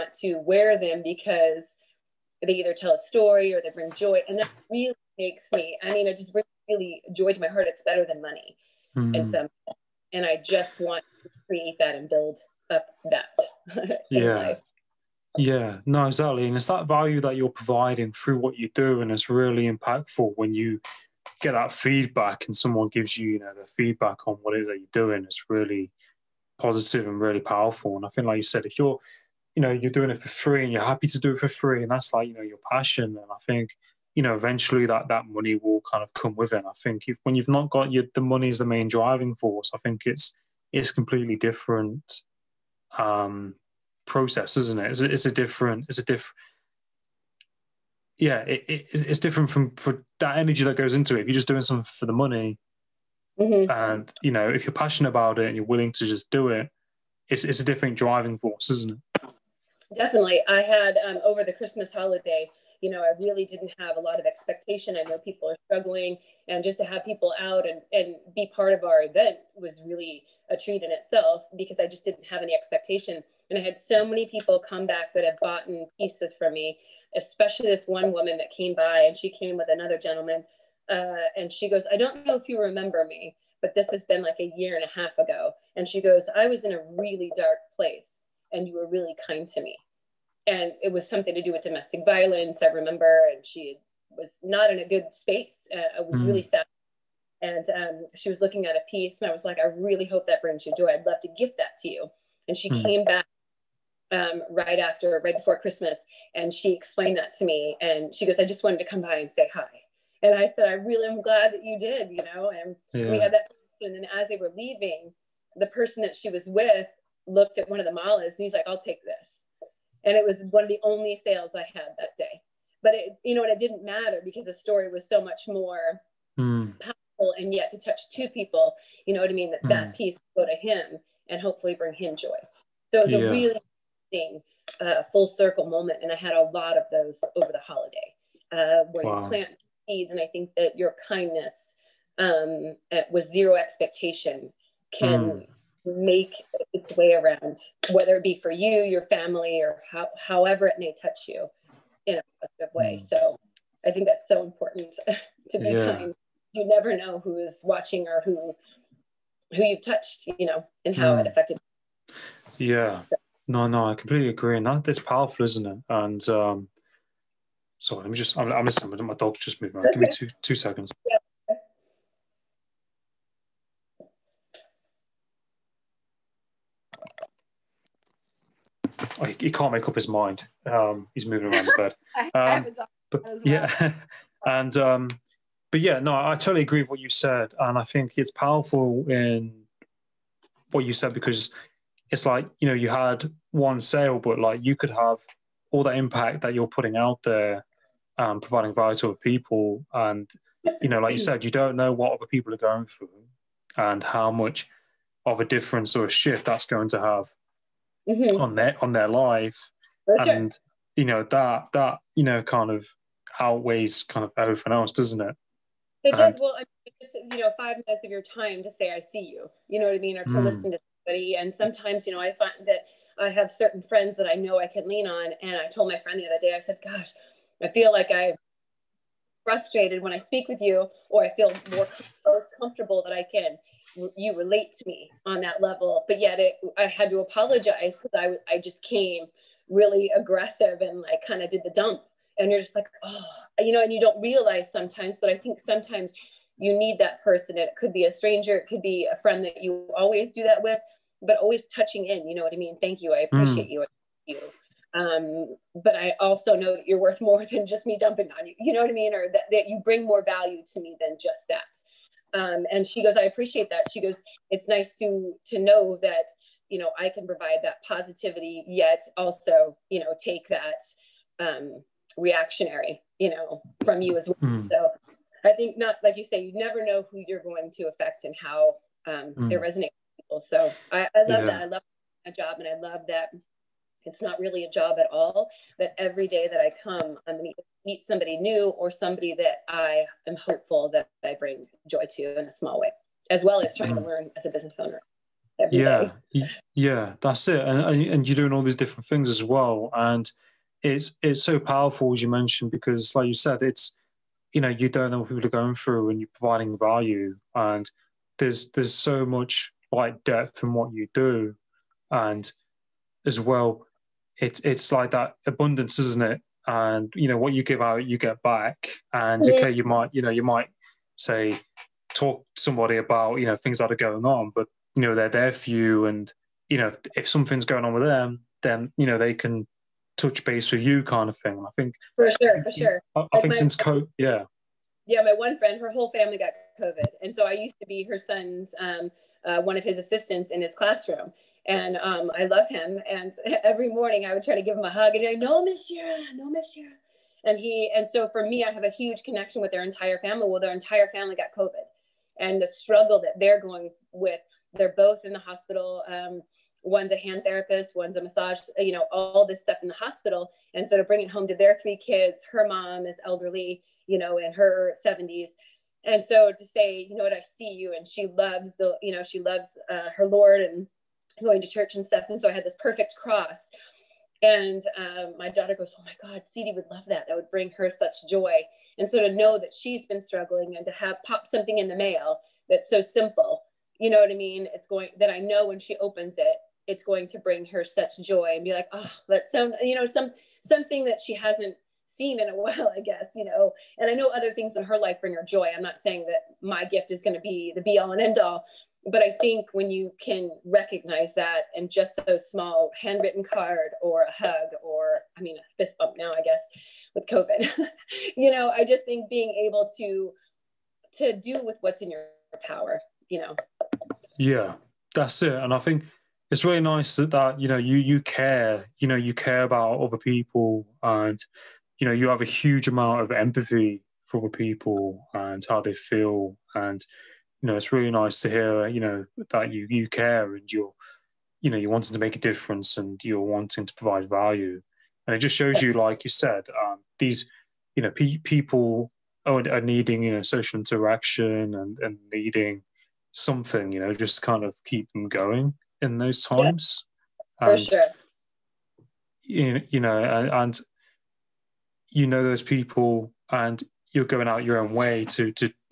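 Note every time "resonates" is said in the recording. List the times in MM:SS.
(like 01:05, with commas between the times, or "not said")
04:39.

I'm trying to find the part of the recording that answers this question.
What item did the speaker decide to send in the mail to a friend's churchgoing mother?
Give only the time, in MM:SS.
06:13.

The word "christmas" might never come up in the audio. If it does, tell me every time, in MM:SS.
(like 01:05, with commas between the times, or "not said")
01:01, 01:45.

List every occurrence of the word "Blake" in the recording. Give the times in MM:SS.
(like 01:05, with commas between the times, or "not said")
not said.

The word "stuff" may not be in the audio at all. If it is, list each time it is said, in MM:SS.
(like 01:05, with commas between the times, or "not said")
05:59, 06:12.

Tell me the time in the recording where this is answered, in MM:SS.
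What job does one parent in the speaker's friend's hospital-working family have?
05:57.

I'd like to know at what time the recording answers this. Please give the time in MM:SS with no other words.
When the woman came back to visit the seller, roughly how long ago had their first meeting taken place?
01:24.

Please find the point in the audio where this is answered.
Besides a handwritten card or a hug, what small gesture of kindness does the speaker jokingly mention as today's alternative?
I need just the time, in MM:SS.
06:45.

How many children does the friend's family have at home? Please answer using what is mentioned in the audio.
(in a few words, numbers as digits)
3.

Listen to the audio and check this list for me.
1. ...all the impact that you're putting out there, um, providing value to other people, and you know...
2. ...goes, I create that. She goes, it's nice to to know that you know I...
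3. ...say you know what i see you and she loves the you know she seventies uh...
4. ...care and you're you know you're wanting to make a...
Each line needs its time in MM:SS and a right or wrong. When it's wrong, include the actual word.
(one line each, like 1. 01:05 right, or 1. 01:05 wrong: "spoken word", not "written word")
1. 03:15 right
2. 04:23 wrong: "appreciate", not "create"
3. 06:06 wrong: "loves", not "seventies"
4. 07:10 right.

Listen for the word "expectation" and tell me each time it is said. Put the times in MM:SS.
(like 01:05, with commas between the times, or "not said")
01:04, 01:12, 02:23.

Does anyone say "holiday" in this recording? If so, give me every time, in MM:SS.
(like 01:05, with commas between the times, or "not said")
01:01, 02:17.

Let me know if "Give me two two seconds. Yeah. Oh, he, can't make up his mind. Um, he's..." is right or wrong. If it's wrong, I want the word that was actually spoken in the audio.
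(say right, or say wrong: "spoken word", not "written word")
right.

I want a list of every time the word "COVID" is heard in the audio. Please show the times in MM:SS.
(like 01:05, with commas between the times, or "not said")
05:36, 05:51, 06:47.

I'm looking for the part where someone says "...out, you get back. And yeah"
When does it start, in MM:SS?
05:17.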